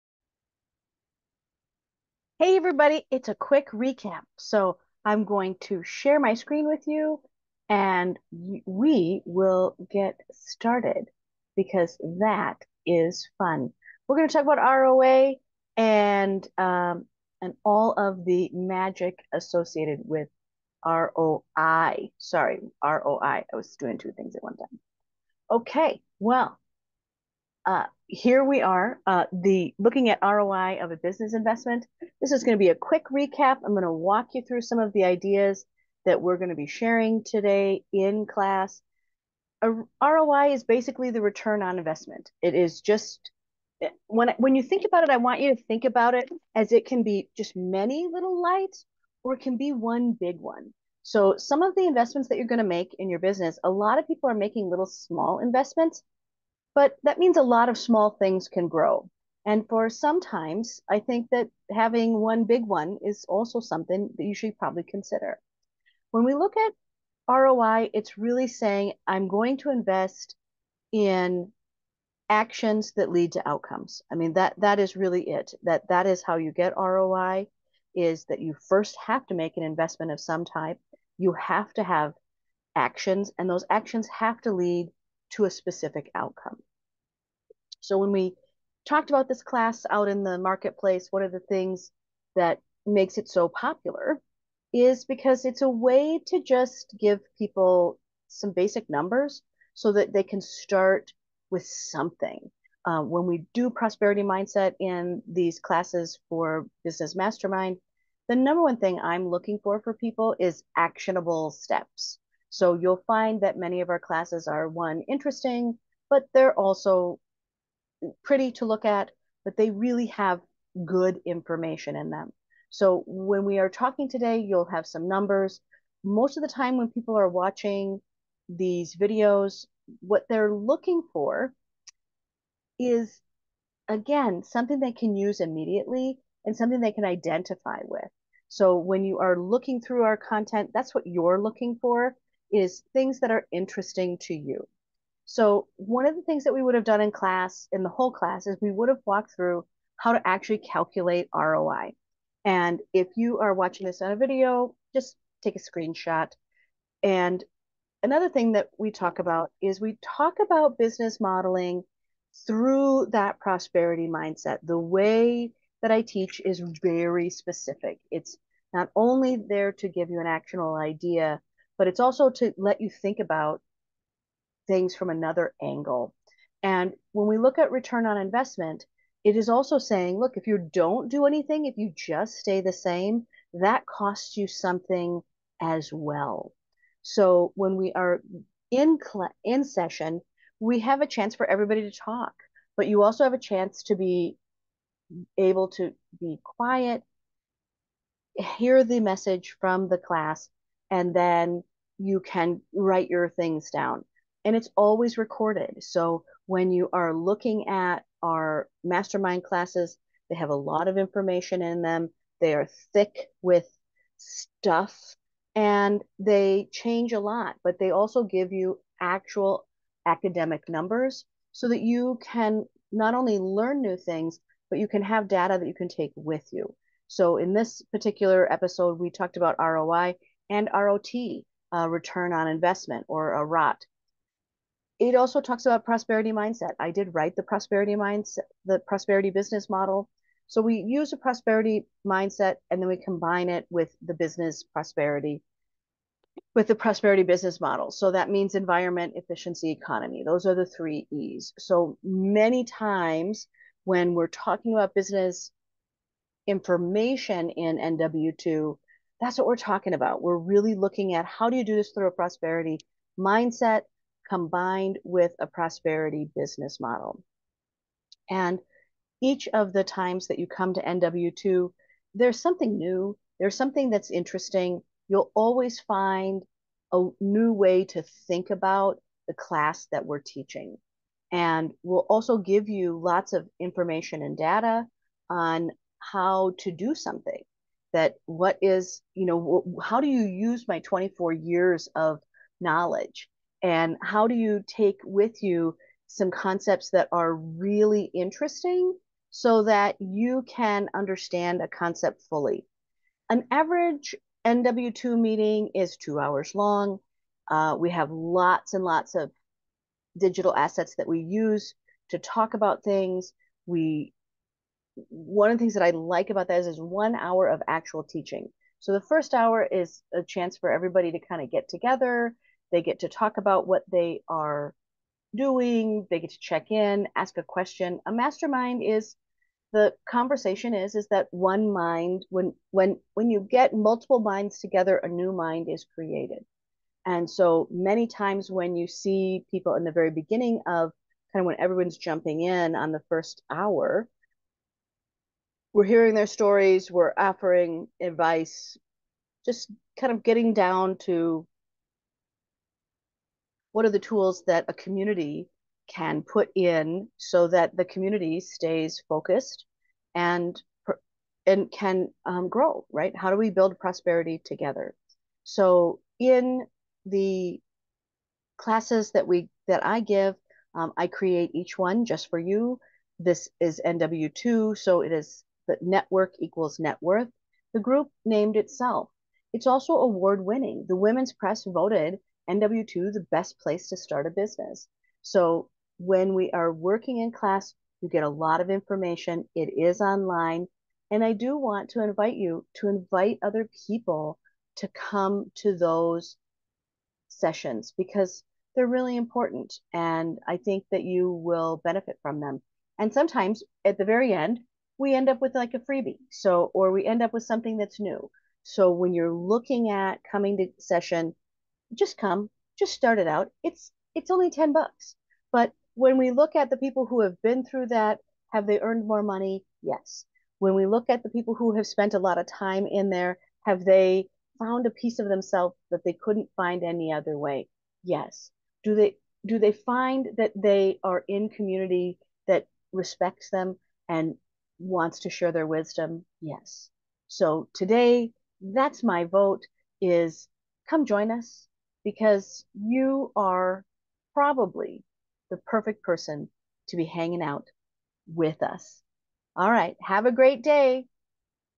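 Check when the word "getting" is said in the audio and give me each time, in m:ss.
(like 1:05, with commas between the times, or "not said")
5:50.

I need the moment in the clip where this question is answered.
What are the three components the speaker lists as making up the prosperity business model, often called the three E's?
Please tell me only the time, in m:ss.
4:08.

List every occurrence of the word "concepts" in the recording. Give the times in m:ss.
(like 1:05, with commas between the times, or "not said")
4:56, 5:01.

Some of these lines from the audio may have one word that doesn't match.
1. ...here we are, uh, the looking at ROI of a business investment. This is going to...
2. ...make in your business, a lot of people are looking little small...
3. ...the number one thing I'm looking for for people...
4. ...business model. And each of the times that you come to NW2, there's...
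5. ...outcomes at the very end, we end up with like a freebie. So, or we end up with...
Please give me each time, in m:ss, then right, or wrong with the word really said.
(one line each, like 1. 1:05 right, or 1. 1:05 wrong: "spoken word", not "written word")
1. 0:28 right
2. 0:52 wrong: "making", not "looking"
3. 1:48 right
4. 4:26 right
5. 6:43 wrong: "sometimes", not "outcomes".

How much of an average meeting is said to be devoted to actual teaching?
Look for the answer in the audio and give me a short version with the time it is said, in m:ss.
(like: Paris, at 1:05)
1 hour, at 5:16.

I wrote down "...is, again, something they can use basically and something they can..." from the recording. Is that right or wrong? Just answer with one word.
wrong.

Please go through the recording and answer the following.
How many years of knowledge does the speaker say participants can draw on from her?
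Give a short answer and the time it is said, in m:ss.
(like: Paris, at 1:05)
24, at 4:50.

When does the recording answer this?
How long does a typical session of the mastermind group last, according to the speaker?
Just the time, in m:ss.
5:05.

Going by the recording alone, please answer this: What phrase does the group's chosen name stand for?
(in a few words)
Network equals net worth.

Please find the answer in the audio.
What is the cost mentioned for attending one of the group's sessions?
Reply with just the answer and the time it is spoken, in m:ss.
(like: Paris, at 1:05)
$10, at 6:54.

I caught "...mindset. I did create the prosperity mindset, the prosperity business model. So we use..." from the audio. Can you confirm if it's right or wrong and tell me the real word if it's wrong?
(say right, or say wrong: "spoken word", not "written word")
wrong: "write", not "create".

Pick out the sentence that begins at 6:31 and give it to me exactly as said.
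And I do want to invite you to invite other people to come to those sessions because they're really important.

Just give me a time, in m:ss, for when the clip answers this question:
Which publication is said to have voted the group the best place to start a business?
6:20.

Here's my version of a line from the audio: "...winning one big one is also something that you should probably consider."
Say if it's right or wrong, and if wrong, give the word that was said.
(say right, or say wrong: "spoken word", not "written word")
wrong: "having", not "winning".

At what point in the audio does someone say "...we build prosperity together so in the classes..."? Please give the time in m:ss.
6:03.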